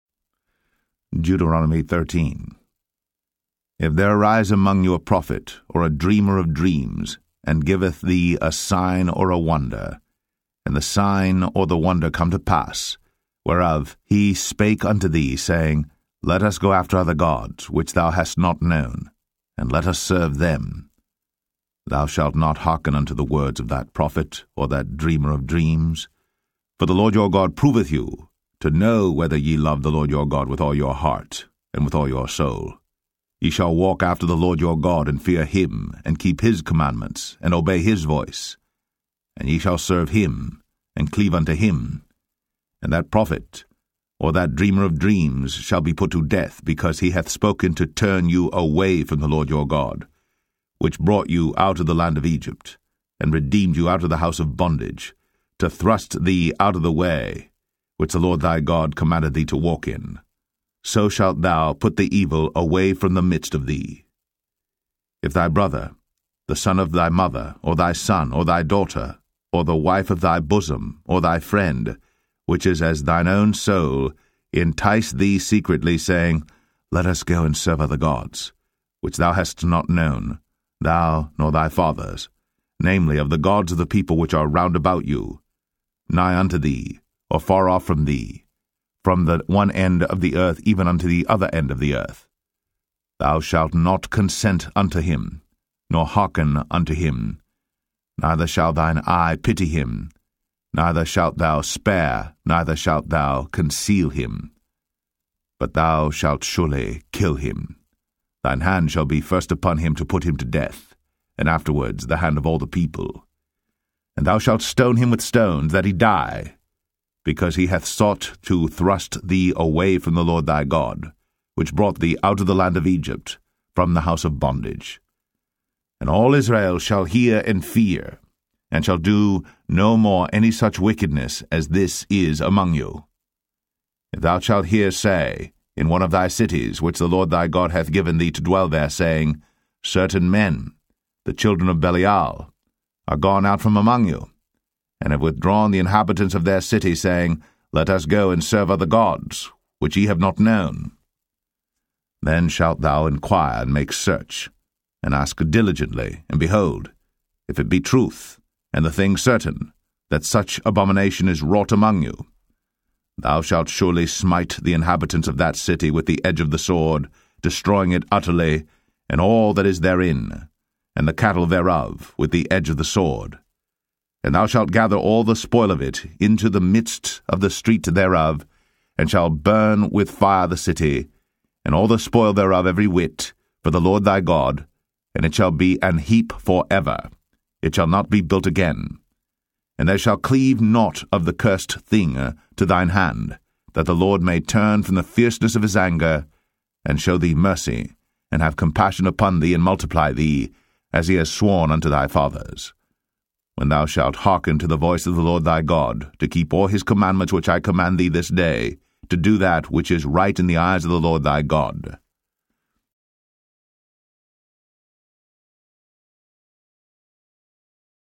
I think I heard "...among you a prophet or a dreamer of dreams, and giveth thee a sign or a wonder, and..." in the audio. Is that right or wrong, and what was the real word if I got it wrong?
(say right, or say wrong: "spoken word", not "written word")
right.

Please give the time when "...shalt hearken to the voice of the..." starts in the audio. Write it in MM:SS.
03:23.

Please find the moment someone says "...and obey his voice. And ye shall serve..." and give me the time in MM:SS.
00:37.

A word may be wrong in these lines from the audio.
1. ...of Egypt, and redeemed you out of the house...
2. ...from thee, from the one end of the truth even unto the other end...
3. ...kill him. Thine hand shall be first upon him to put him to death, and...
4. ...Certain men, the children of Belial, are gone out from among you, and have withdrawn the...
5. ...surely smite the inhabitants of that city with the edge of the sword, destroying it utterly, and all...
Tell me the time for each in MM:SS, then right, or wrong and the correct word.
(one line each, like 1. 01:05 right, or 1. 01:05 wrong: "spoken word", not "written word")
1. 00:52 right
2. 01:27 wrong: "earth", not "truth"
3. 01:47 right
4. 02:19 right
5. 02:43 right.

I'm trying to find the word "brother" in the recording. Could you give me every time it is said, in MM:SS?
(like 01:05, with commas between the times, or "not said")
01:05.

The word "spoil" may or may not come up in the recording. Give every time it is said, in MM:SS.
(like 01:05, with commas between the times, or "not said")
02:55, 03:01.